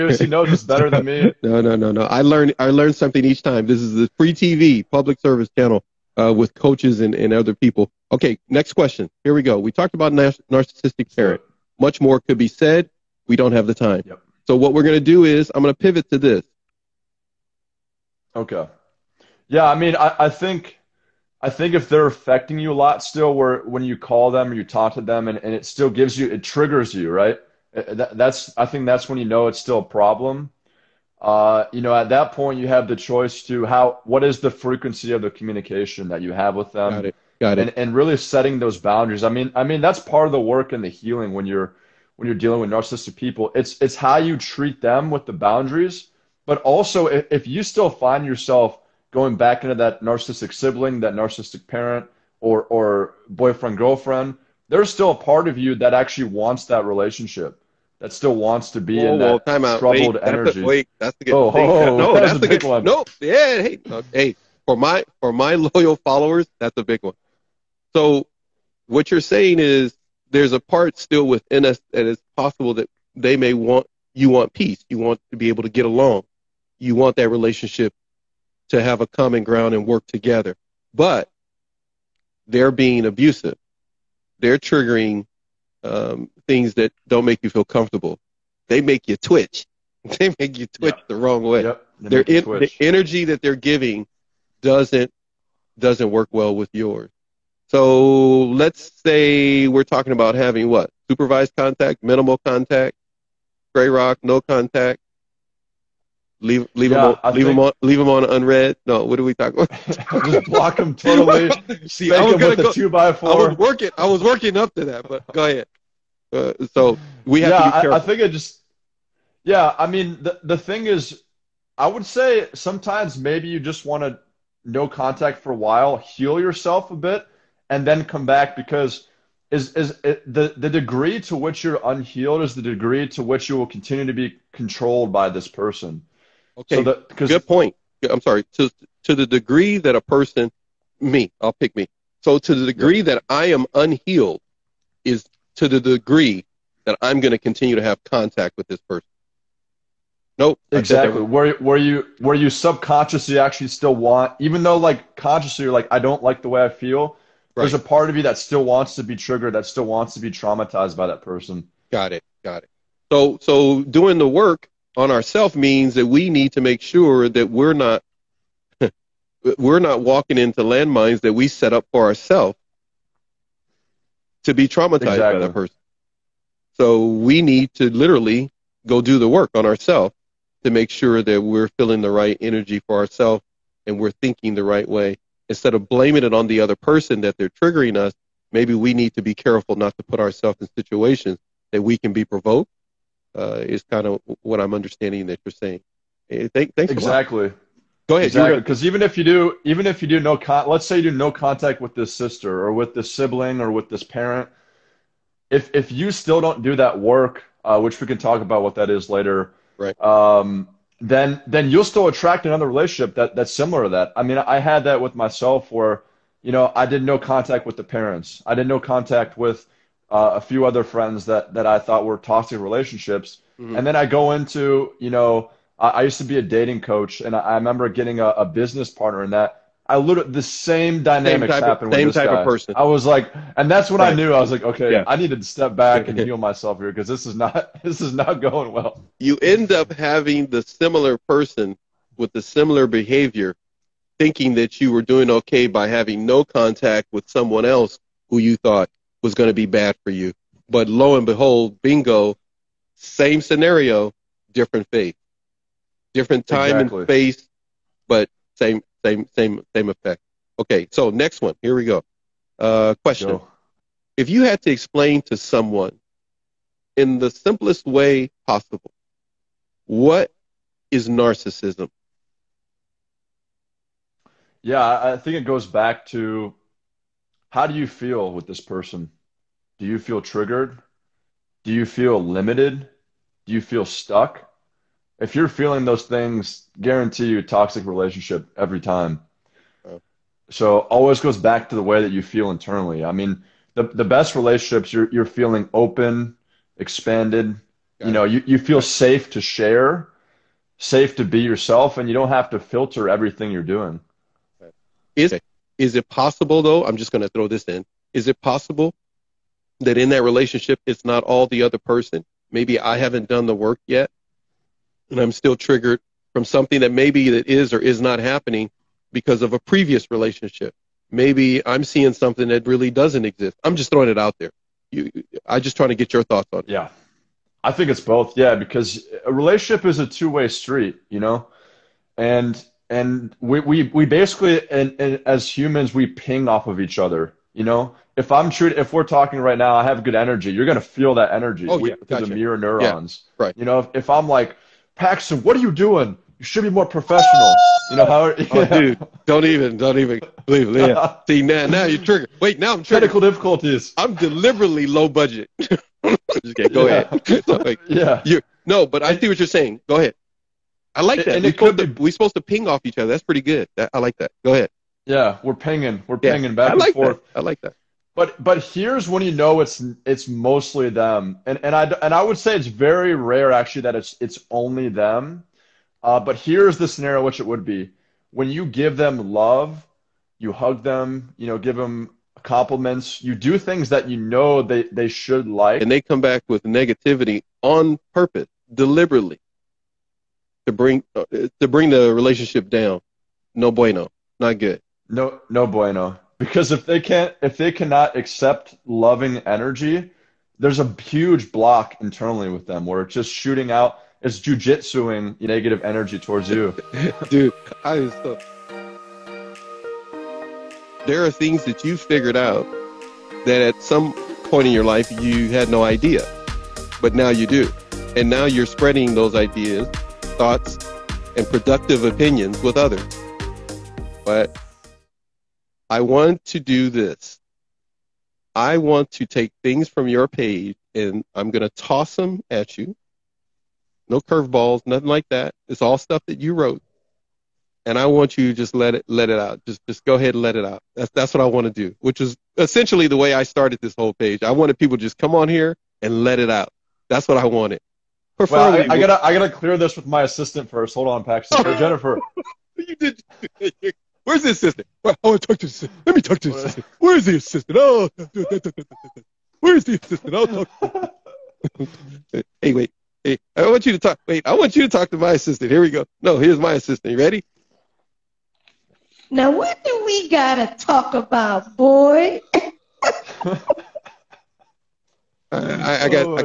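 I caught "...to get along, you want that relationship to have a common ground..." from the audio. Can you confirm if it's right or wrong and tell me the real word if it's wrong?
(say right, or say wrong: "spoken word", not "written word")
right.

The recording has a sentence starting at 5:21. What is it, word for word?
Maybe I'm seeing something that really doesn't exist.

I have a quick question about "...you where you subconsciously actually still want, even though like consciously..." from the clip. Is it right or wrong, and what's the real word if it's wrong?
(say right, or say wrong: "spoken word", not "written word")
right.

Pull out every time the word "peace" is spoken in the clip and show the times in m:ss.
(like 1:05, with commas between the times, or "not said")
1:14.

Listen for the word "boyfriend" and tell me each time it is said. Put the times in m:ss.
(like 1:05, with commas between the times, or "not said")
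0:53.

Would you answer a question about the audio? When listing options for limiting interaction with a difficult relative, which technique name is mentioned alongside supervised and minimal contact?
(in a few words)
gray rock.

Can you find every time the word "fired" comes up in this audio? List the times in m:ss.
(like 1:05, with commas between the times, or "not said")
not said.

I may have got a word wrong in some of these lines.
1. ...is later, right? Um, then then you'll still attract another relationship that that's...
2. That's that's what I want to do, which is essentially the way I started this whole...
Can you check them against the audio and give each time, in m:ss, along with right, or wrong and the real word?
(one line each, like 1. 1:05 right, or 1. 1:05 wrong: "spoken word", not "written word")
1. 3:28 right
2. 7:20 right.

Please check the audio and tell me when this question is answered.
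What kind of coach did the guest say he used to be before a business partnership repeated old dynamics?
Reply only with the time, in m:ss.
3:46.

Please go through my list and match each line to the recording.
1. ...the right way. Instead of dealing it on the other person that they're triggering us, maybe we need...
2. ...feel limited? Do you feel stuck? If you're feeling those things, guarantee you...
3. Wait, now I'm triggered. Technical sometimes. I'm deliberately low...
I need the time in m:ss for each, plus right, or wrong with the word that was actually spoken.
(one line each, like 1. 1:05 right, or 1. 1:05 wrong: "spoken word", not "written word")
1. 3:04 wrong: "blaming", not "dealing"
2. 4:41 right
3. 5:52 wrong: "difficulties", not "sometimes".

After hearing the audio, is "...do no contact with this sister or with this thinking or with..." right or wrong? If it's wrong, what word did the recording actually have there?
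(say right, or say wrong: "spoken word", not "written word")
wrong: "sibling", not "thinking".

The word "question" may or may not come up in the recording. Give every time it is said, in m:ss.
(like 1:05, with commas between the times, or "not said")
0:08, 4:23.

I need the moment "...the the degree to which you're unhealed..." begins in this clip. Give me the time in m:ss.
2:10.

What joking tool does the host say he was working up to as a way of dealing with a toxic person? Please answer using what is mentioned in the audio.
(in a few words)
two by four.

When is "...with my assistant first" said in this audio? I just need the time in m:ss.
7:29.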